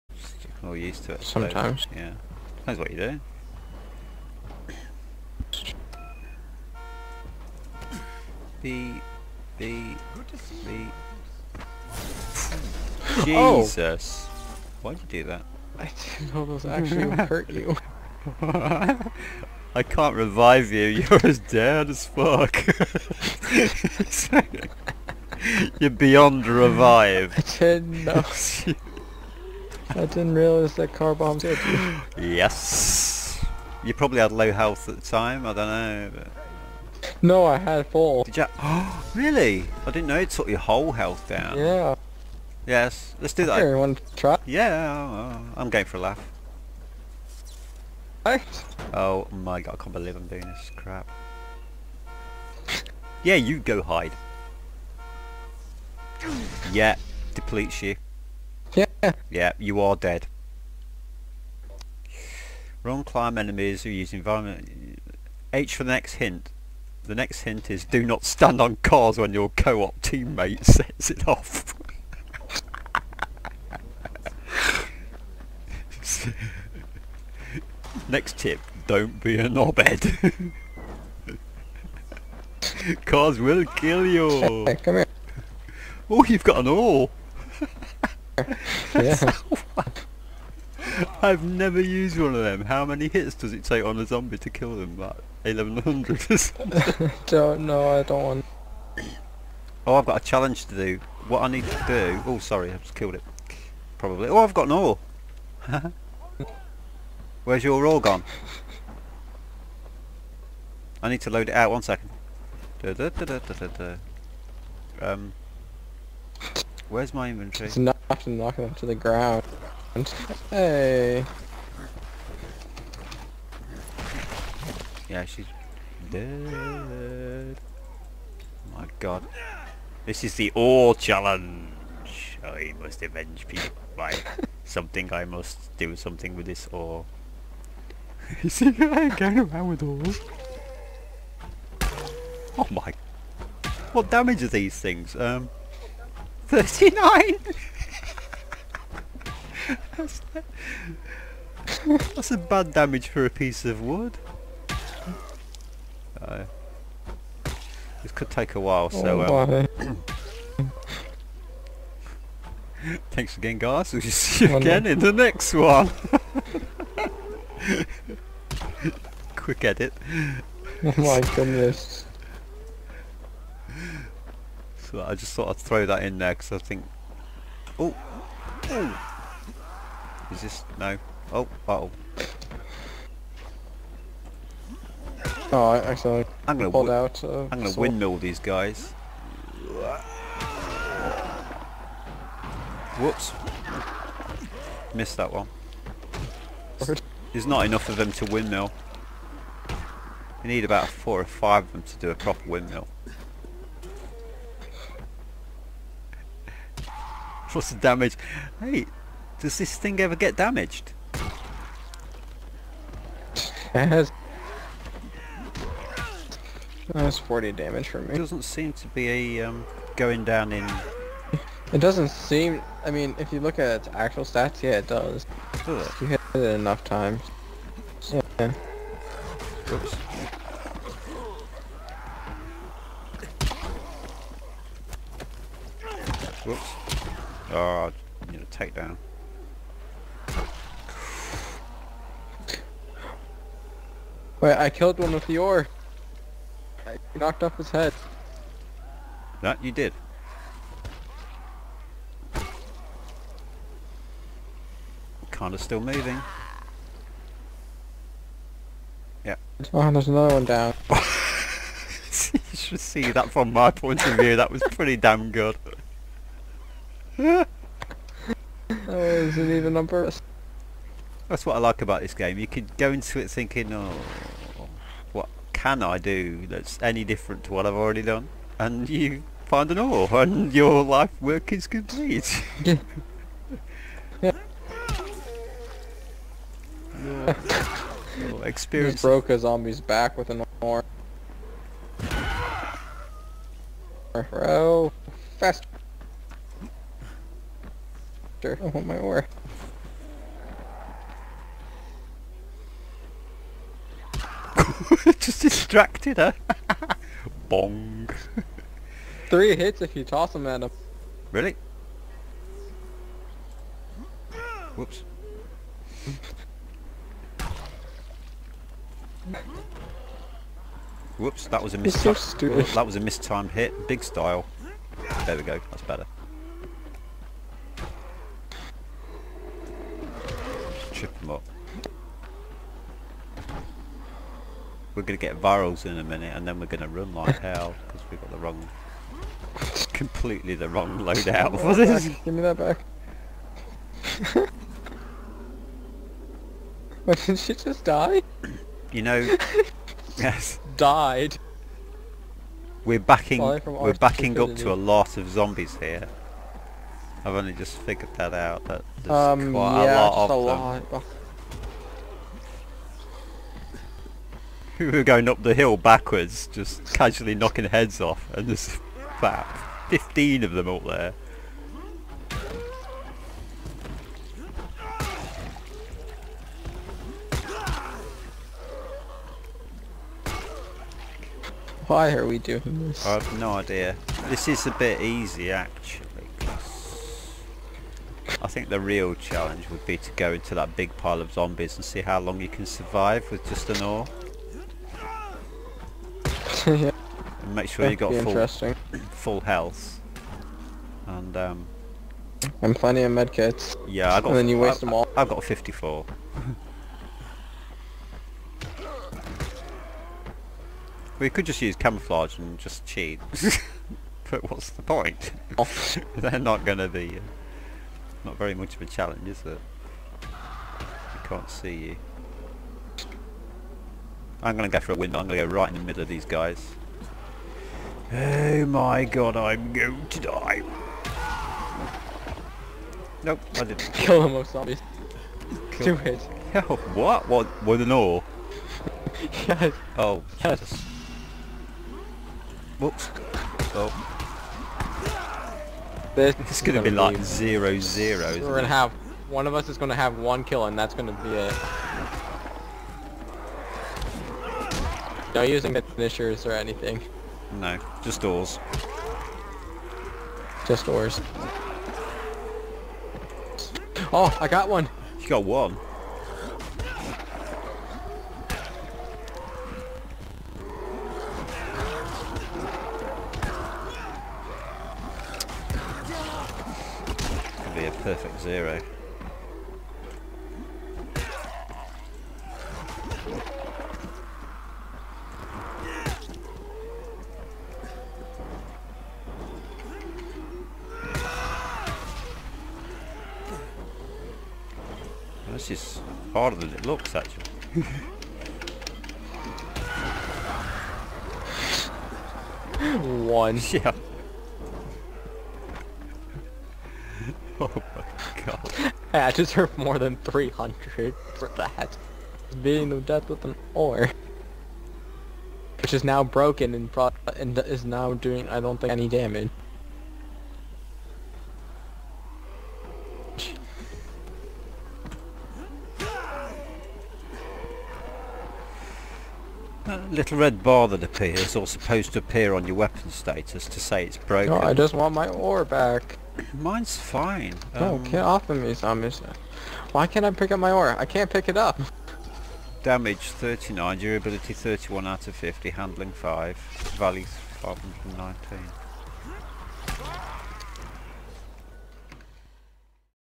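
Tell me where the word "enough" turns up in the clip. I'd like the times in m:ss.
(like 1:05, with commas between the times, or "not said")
3:17, 3:46.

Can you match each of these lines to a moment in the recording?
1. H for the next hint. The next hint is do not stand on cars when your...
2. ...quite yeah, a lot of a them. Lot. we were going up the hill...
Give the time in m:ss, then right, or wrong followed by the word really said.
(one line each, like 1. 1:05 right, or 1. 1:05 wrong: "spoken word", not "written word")
1. 1:05 right
2. 5:59 right.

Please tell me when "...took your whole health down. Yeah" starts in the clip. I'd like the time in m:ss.
0:40.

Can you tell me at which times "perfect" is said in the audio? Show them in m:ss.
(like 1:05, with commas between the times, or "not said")
7:58.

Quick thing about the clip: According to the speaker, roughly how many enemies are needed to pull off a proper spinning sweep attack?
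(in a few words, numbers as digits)
4 or 5.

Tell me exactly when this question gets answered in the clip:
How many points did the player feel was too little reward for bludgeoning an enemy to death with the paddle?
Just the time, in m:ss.
8:30.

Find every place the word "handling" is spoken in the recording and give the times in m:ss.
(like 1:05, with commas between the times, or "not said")
9:05.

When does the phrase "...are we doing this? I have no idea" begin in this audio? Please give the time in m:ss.
6:22.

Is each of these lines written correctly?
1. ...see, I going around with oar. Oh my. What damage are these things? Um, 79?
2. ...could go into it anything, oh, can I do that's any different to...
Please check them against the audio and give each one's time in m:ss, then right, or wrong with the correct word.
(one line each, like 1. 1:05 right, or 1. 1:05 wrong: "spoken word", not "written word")
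1. 2:18 wrong: "39", not "79"
2. 4:32 wrong: "thinking", not "anything".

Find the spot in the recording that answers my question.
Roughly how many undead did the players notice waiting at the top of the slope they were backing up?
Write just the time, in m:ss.
6:09.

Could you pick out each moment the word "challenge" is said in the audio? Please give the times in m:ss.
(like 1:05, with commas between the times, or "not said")
1:40, 2:10, 6:29, 6:58.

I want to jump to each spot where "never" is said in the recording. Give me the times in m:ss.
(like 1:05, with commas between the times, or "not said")
1:31.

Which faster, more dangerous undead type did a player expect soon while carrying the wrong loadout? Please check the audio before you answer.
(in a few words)
virals.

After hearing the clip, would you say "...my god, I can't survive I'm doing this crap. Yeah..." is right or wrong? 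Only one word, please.
wrong.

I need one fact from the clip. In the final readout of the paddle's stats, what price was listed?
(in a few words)
519.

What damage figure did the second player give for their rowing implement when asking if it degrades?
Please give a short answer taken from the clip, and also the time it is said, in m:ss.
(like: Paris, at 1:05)
40, at 3:37.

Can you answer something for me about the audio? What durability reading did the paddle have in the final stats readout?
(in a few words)
31 out of 50.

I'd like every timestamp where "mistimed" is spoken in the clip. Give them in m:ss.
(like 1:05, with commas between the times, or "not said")
5:22.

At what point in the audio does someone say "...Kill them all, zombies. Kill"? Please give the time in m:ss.
7:13.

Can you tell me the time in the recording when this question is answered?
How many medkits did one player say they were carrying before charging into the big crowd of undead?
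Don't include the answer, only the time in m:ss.
6:45.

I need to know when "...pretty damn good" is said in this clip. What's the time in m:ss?
4:24.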